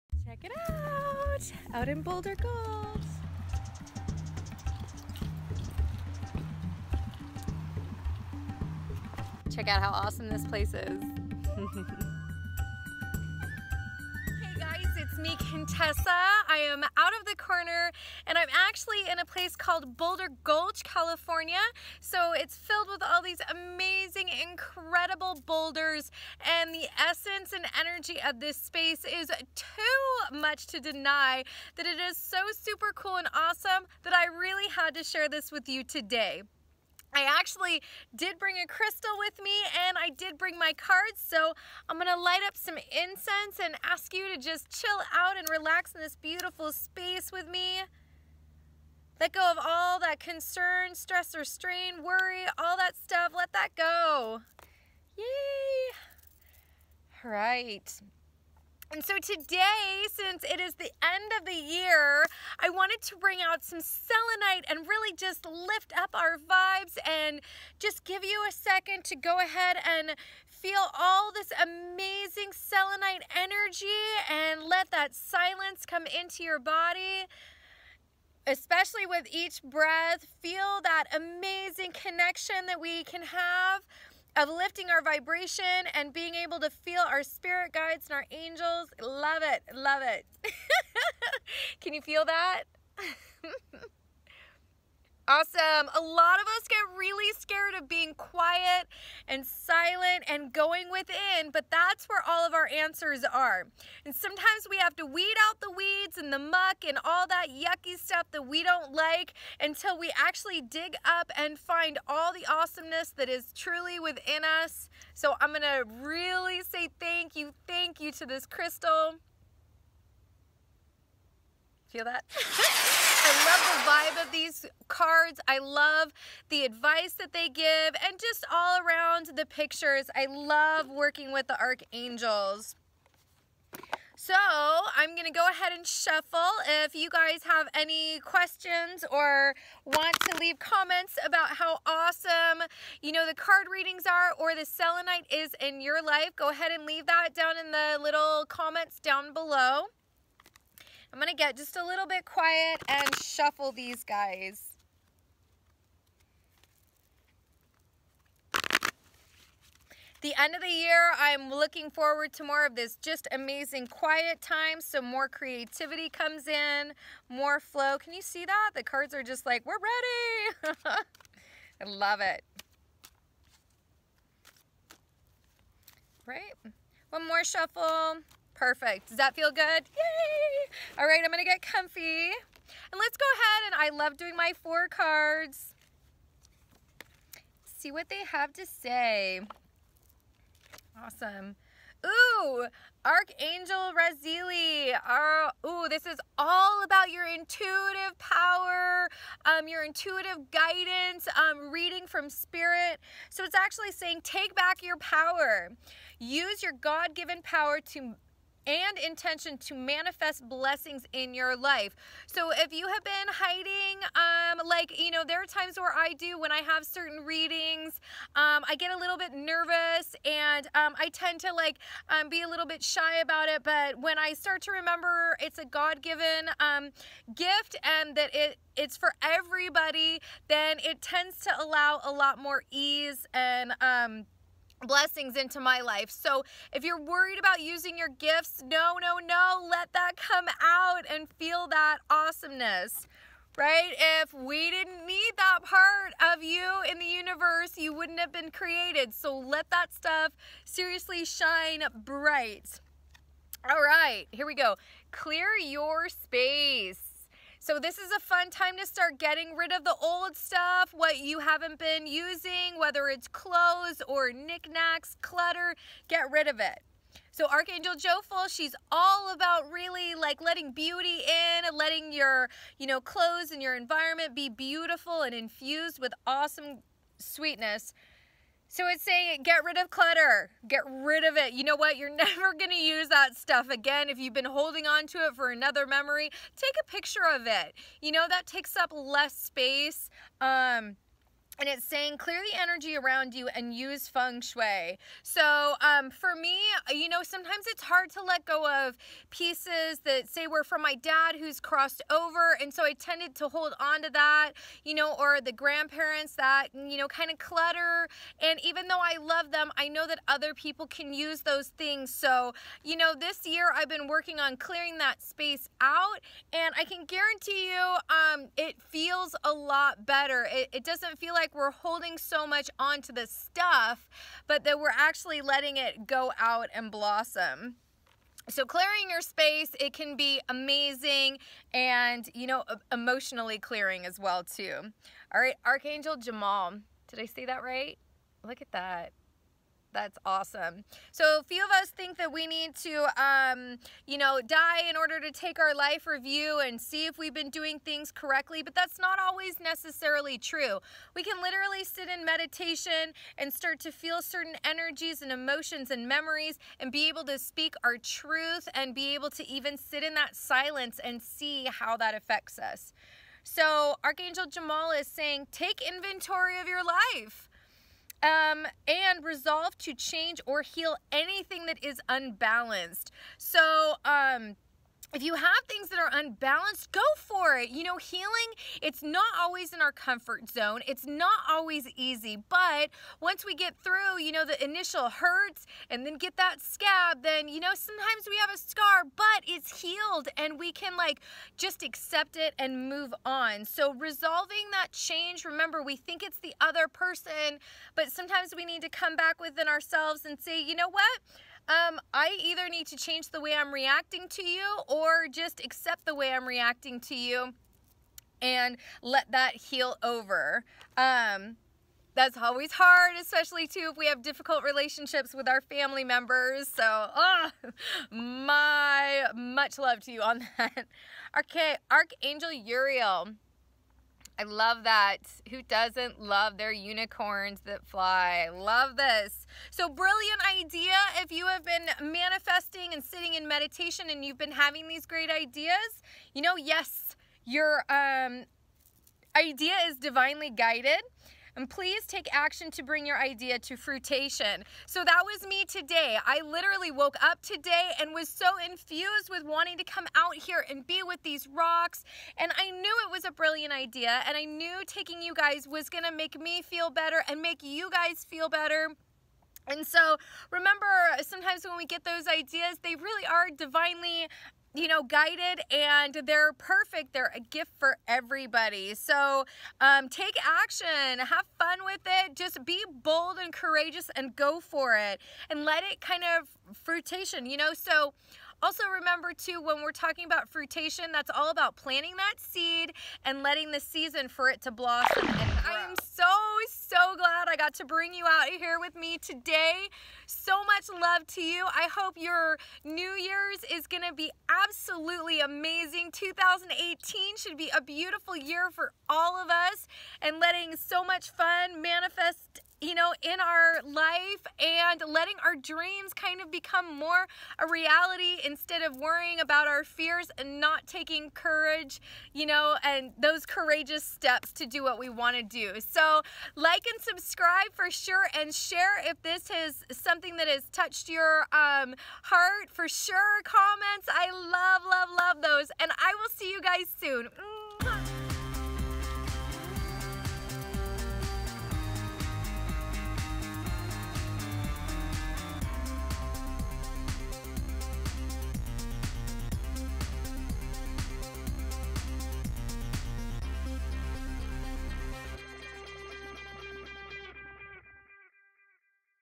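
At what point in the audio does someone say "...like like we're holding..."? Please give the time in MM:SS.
05:21.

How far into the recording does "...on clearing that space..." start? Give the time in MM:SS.
05:14.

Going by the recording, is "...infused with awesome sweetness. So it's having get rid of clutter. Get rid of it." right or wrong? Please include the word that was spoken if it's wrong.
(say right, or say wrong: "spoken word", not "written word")
wrong: "saying", not "having".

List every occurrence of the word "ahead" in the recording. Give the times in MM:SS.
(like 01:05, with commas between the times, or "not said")
01:09, 02:15, 02:26, 03:03.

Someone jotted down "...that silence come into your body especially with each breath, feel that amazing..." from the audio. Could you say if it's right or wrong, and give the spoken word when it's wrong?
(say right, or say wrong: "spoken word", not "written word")
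right.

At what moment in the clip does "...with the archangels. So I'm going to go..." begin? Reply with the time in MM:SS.
02:11.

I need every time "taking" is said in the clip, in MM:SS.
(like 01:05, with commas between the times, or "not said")
07:34, 08:30.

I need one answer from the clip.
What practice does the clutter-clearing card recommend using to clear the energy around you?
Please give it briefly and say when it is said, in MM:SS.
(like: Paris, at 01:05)
Feng shui, at 04:54.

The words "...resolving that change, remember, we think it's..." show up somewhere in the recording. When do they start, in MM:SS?
06:33.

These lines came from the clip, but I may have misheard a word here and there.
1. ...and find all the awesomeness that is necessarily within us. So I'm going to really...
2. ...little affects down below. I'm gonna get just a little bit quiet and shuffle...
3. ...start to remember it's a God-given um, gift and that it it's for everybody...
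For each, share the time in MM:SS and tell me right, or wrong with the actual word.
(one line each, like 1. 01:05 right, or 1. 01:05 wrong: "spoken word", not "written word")
1. 01:51 wrong: "truly", not "necessarily"
2. 02:28 wrong: "comments", not "affects"
3. 03:44 right.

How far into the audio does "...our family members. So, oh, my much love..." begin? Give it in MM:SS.
06:55.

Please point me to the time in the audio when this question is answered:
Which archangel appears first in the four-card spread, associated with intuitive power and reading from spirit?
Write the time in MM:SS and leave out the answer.
03:13.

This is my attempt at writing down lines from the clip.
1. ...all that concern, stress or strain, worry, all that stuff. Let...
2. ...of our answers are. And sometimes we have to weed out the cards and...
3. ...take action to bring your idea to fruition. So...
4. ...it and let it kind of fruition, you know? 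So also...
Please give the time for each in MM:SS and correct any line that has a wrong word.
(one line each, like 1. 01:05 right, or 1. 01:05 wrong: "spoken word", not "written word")
1. 00:49 right
2. 01:42 wrong: "weeds", not "cards"
3. 07:22 right
4. 07:54 right.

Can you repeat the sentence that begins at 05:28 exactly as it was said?
So clearing your space, it can be amazing and, you know, emotionally clearing as well too.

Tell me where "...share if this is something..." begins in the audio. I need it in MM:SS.
08:38.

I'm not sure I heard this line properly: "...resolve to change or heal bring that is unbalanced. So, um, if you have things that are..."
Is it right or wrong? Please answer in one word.
wrong.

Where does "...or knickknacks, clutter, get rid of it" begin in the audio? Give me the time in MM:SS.
04:24.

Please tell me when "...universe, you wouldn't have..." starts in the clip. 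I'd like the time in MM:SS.
04:07.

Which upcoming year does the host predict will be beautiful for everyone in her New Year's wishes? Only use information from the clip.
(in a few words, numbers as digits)
2018.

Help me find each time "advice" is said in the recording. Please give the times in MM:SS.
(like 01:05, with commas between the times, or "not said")
02:06.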